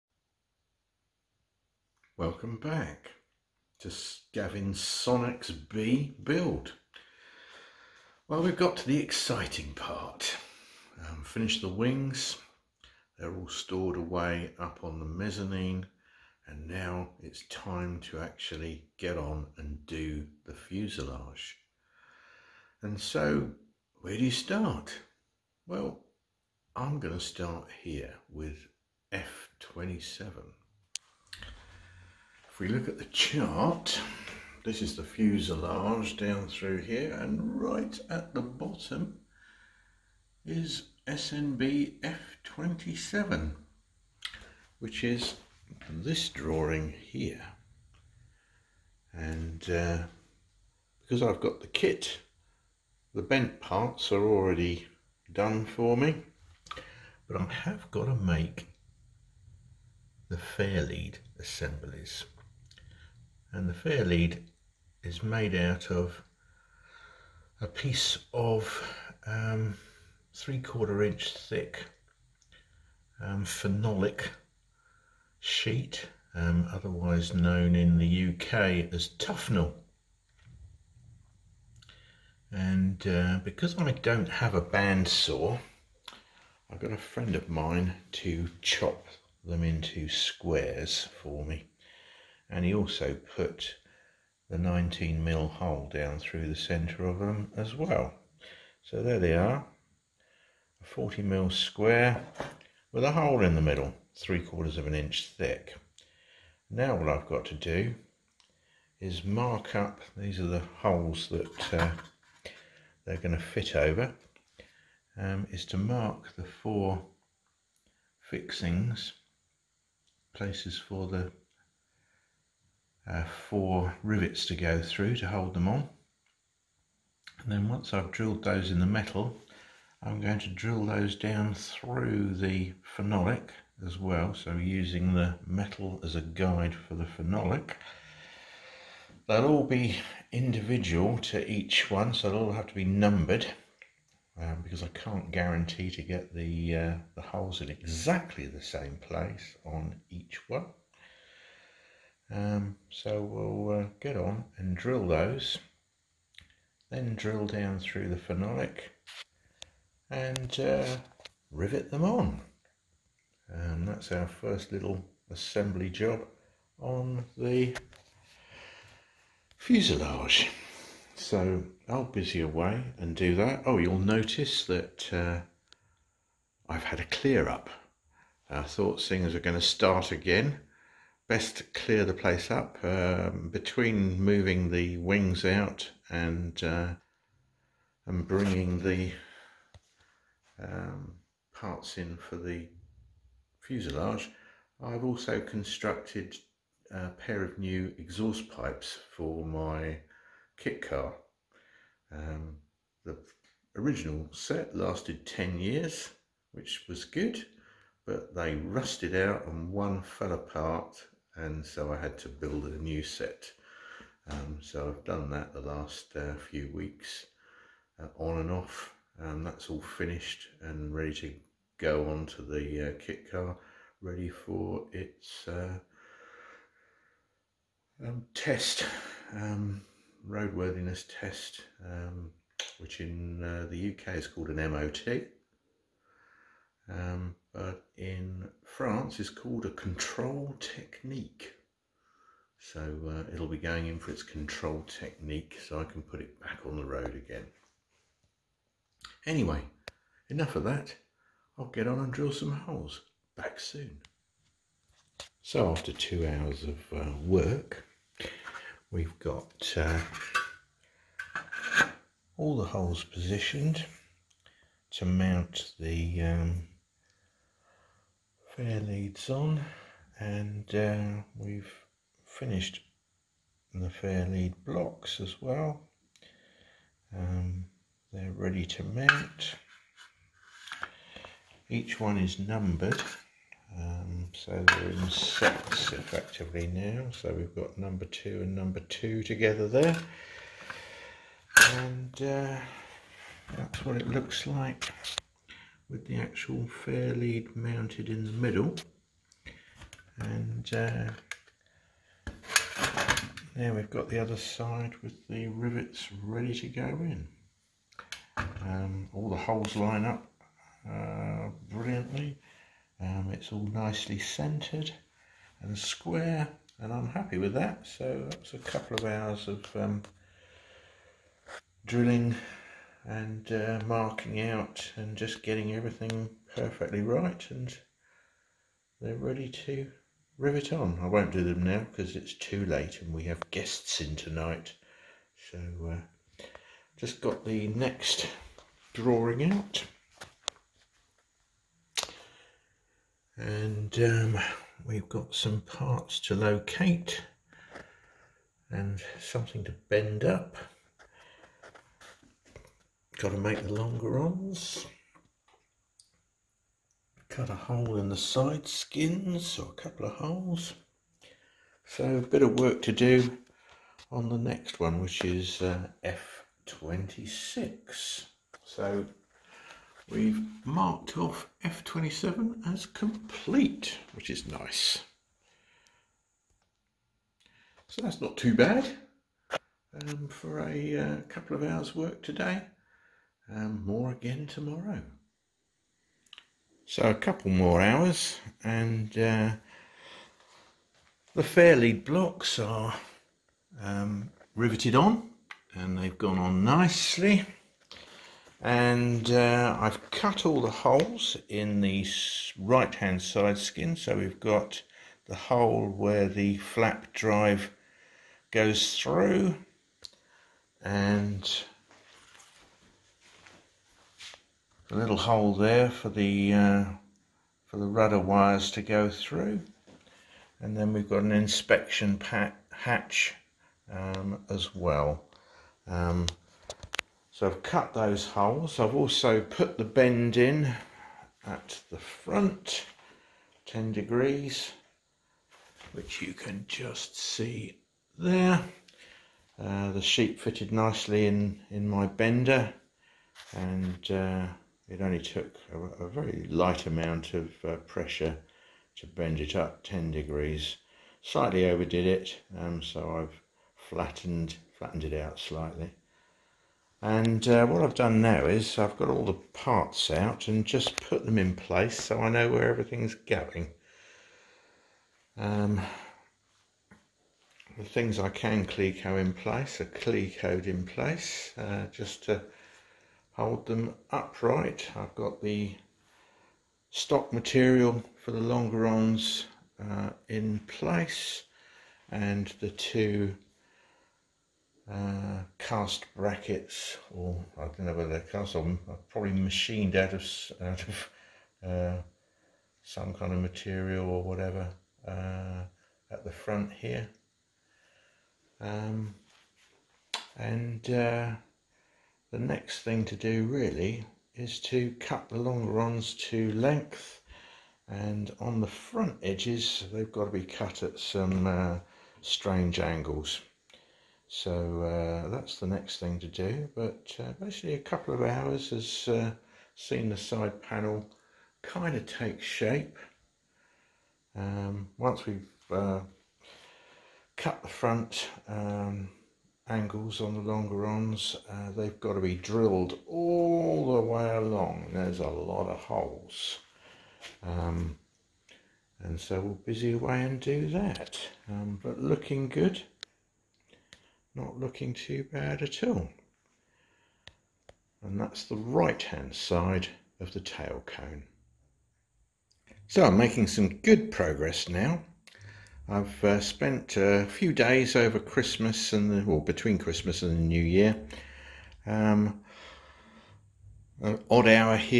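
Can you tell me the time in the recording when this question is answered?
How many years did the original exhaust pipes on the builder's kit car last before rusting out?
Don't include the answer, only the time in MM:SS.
03:25.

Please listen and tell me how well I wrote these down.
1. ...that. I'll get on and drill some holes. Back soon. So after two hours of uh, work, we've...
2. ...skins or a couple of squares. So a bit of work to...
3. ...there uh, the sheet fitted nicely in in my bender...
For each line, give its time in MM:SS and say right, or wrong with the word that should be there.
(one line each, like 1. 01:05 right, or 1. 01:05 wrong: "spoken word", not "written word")
1. 04:10 right
2. 05:58 wrong: "holes", not "squares"
3. 07:18 right.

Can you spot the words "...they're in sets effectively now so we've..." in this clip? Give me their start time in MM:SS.
04:44.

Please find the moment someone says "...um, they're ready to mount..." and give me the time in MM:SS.
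04:37.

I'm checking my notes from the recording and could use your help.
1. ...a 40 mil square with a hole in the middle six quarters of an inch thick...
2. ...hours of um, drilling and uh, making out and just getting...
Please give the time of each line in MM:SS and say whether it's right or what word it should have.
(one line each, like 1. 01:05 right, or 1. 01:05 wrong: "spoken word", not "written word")
1. 01:40 wrong: "three", not "six"
2. 05:19 wrong: "marking", not "making".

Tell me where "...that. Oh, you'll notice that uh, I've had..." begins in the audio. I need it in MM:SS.
02:53.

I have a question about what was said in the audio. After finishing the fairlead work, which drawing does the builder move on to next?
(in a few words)
F26.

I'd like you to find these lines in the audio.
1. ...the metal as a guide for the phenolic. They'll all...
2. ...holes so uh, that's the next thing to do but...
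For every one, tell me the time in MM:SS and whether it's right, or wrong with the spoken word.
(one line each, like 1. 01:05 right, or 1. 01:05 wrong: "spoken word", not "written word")
1. 02:15 right
2. 08:32 wrong: "angles", not "holes".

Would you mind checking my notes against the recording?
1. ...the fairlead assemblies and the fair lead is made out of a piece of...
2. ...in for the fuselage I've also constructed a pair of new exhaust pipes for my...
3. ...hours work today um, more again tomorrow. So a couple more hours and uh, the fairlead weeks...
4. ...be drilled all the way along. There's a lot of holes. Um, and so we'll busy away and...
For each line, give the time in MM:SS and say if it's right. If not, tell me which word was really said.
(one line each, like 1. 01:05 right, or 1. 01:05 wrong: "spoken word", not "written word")
1. 01:00 right
2. 03:11 right
3. 06:21 wrong: "blocks", not "weeks"
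4. 08:52 right.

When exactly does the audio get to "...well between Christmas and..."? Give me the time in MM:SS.
09:19.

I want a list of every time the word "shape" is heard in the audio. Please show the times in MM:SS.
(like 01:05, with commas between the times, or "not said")
08:42.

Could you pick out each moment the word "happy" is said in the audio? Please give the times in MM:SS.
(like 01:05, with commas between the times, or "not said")
05:17.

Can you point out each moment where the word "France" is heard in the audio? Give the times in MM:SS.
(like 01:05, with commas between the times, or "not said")
03:58.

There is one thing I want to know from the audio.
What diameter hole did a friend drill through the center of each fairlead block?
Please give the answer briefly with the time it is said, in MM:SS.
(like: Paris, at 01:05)
19 mm, at 01:34.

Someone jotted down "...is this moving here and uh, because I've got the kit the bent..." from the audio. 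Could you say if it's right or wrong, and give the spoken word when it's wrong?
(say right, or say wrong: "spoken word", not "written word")
wrong: "drawing", not "moving".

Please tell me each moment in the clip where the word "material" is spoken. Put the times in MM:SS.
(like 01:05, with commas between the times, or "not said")
07:57, 08:13.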